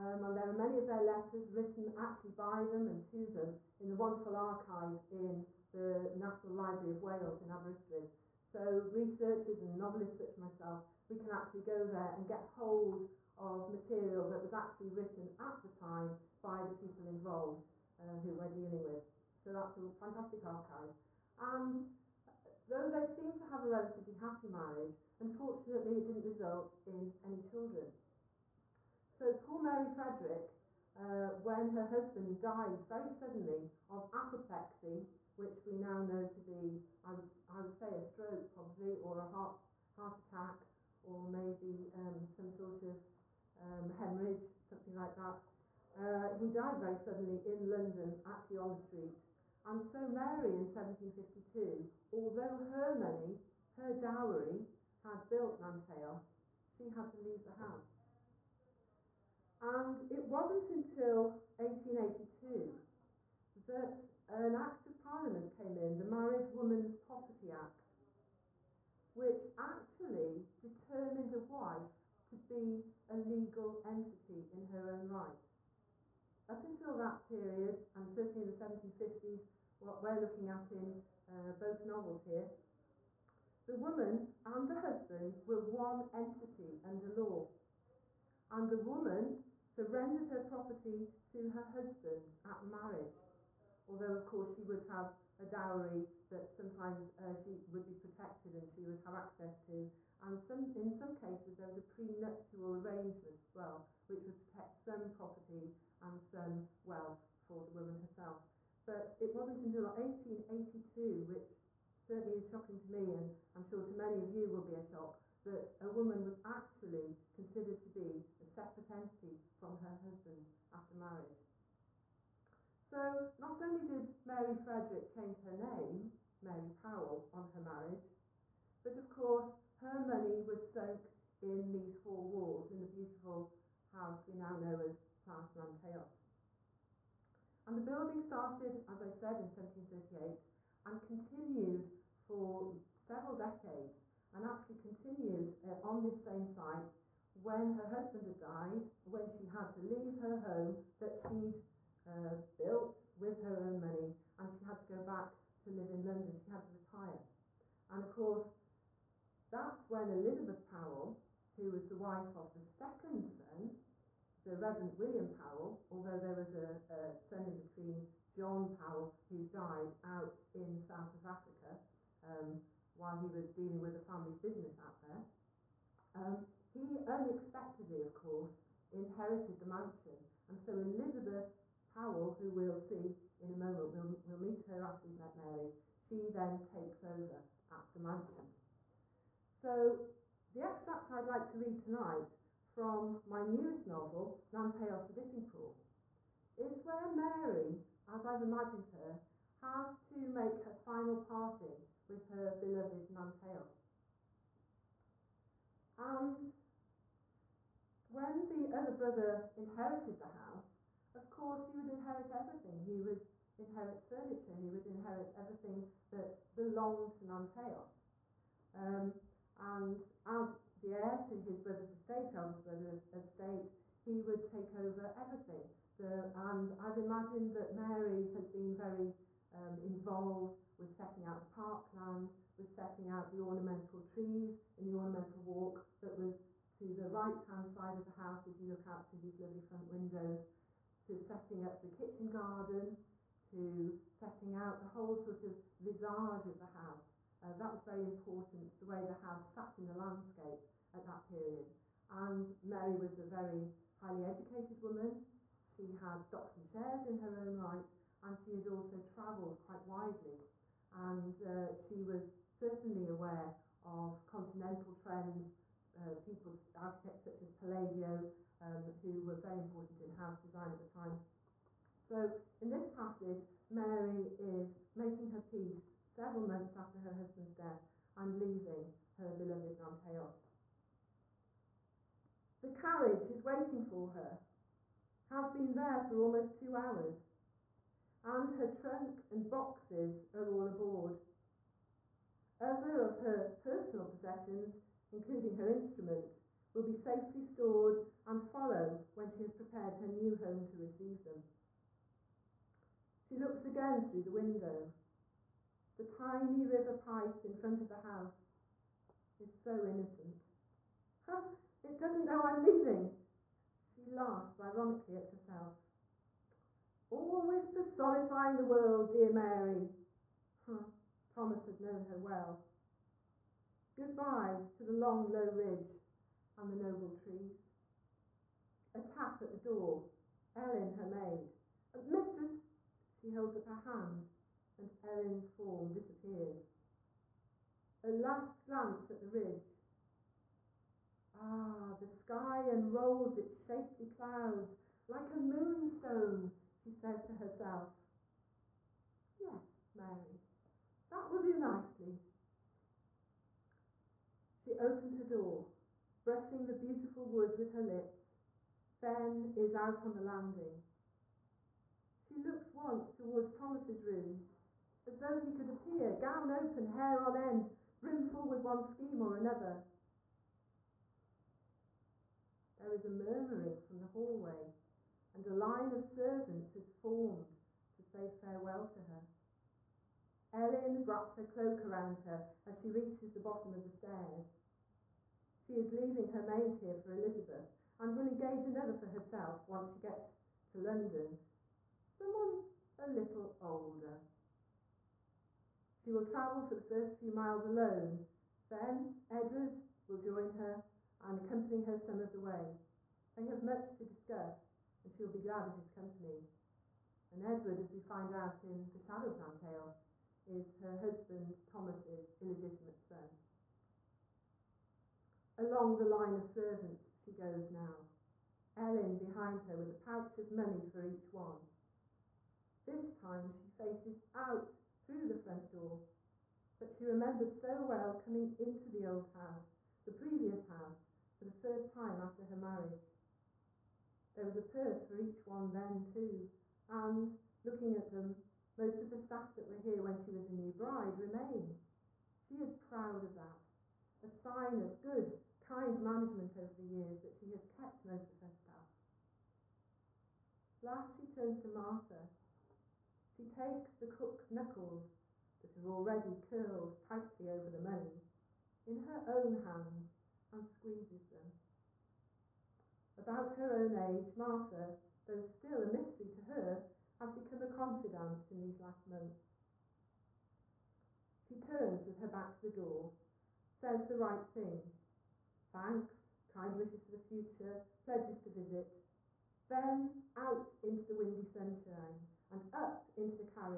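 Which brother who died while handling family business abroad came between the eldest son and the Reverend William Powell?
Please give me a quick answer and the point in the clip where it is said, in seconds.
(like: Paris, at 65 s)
John Powell, at 168 s.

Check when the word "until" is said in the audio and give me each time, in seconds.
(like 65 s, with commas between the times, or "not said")
60 s, 76 s, 109 s.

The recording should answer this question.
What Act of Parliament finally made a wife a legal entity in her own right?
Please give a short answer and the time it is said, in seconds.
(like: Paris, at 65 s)
Married Woman's Property Act, at 65 s.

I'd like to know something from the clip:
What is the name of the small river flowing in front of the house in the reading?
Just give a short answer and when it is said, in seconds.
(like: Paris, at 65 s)
Pythe, at 307 s.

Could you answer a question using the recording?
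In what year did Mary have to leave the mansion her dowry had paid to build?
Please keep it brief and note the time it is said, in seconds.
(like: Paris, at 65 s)
1752, at 50 s.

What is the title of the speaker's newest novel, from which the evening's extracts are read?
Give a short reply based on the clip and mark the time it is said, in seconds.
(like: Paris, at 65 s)
Nanteos the Dipping Pool, at 194 s.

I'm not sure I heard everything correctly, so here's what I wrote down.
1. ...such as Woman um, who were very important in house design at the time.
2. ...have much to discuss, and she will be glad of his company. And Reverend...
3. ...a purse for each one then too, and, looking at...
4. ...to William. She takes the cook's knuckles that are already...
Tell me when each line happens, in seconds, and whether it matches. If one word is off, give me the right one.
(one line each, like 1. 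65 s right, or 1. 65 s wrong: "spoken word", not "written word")
1. 267 s wrong: "Palladio", not "Woman"
2. 403 s wrong: "Edward", not "Reverend"
3. 434 s right
4. 451 s wrong: "Martha", not "William".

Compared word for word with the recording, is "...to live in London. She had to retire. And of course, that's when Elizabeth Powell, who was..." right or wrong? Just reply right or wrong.
right.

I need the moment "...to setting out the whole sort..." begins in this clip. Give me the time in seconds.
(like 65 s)
243 s.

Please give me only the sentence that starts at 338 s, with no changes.
A last glance at the ridge.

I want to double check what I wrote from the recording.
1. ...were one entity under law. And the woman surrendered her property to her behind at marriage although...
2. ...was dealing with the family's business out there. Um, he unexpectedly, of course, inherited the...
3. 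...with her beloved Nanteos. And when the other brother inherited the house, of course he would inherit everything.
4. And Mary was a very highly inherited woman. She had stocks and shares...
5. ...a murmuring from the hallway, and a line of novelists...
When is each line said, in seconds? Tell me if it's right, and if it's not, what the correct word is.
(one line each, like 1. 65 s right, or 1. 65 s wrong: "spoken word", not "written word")
1. 85 s wrong: "husband", not "behind"
2. 173 s right
3. 202 s right
4. 252 s wrong: "educated", not "inherited"
5. 373 s wrong: "servants", not "novelists".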